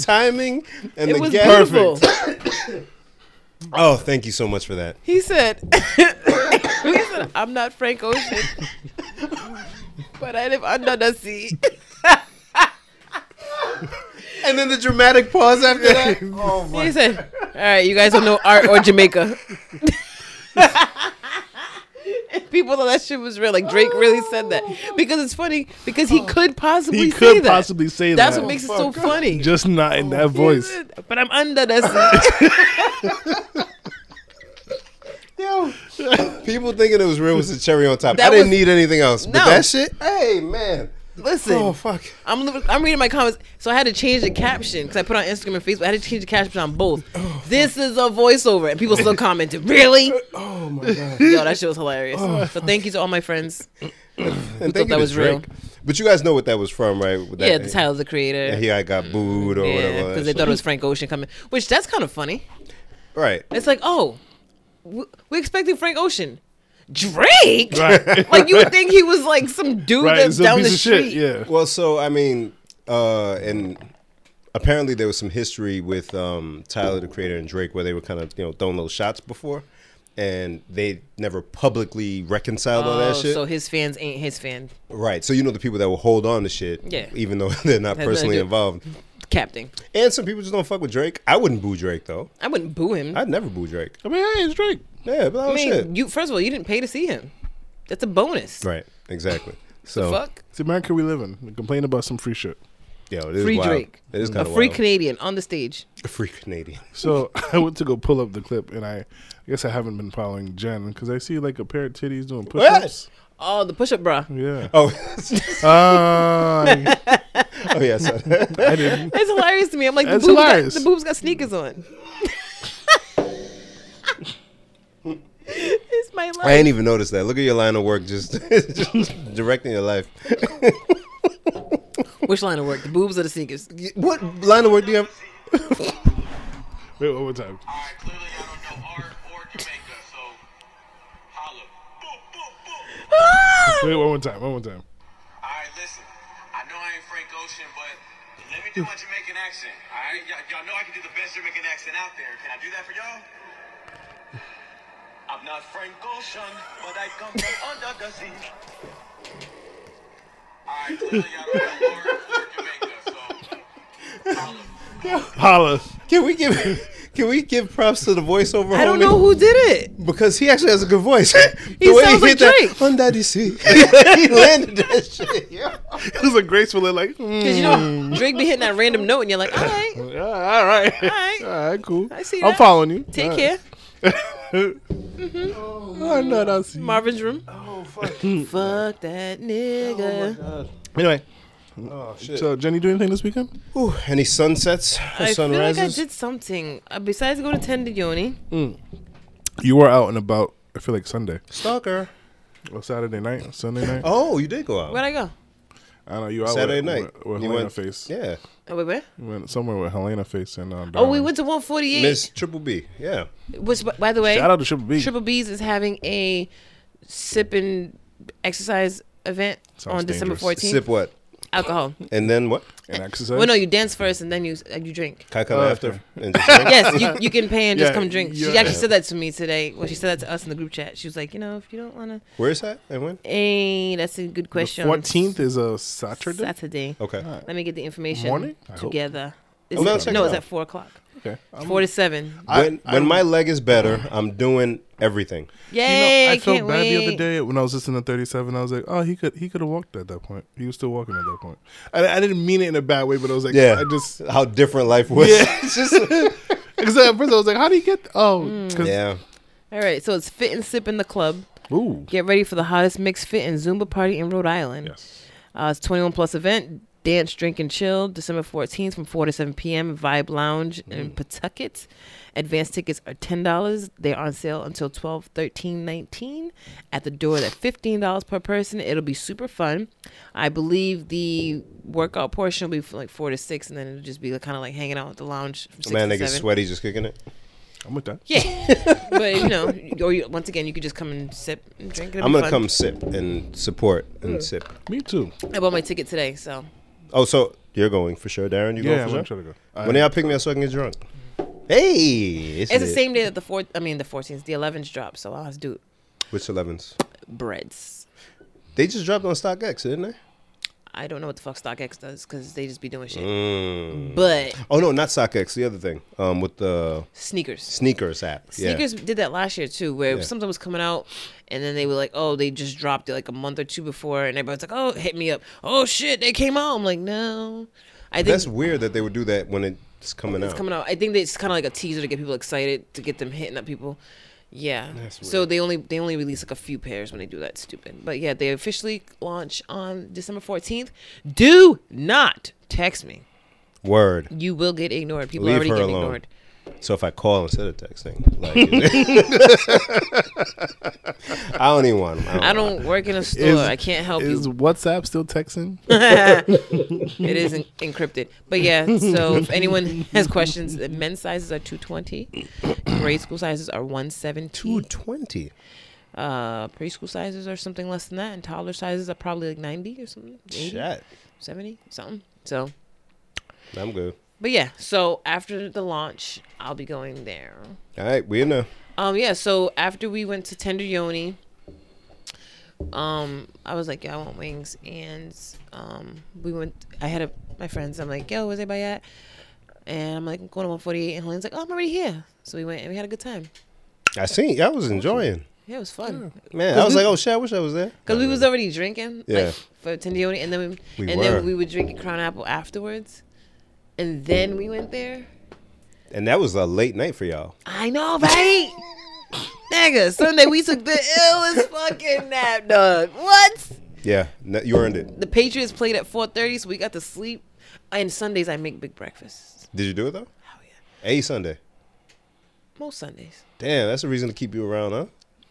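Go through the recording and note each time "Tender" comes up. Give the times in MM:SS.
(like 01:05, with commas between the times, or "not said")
03:17, 06:20, 06:39.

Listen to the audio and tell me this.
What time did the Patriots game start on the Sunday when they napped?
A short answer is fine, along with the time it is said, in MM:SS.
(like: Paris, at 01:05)
4:30, at 06:56.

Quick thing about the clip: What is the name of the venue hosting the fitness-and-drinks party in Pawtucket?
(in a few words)
Vibe Lounge.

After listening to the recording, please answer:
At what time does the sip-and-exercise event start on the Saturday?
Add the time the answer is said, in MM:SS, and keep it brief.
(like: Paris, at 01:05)
4 o'clock, at 04:00.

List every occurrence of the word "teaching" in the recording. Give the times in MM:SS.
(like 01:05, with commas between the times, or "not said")
not said.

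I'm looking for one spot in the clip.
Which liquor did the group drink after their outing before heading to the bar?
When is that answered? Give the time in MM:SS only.
06:41.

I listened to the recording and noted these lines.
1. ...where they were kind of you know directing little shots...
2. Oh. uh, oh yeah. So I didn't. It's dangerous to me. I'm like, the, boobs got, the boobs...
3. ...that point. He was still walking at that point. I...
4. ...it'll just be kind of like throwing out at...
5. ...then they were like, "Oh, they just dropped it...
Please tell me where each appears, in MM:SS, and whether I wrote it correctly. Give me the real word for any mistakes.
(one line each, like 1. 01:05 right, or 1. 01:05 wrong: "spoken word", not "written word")
1. 01:17 wrong: "throwing", not "directing"
2. 01:54 wrong: "hilarious", not "dangerous"
3. 04:10 right
4. 04:43 wrong: "hanging", not "throwing"
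5. 05:21 right.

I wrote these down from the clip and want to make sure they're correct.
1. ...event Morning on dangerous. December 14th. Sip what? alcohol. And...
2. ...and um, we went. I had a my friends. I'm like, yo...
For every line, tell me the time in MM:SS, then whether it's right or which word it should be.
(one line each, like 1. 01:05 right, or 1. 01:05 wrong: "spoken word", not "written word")
1. 03:39 wrong: "Sounds", not "Morning"
2. 06:24 right.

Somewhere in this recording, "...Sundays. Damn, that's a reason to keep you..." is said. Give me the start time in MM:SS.
07:02.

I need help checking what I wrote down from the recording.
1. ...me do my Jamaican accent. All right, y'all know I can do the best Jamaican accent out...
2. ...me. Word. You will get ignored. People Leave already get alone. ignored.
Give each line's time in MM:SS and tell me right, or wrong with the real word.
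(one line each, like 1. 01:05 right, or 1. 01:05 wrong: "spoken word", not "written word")
1. 02:28 right
2. 05:43 right.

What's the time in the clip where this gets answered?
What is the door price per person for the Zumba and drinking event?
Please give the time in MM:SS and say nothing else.
04:37.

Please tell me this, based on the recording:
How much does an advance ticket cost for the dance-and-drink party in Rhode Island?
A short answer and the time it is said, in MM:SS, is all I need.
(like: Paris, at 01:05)
$10, at 04:33.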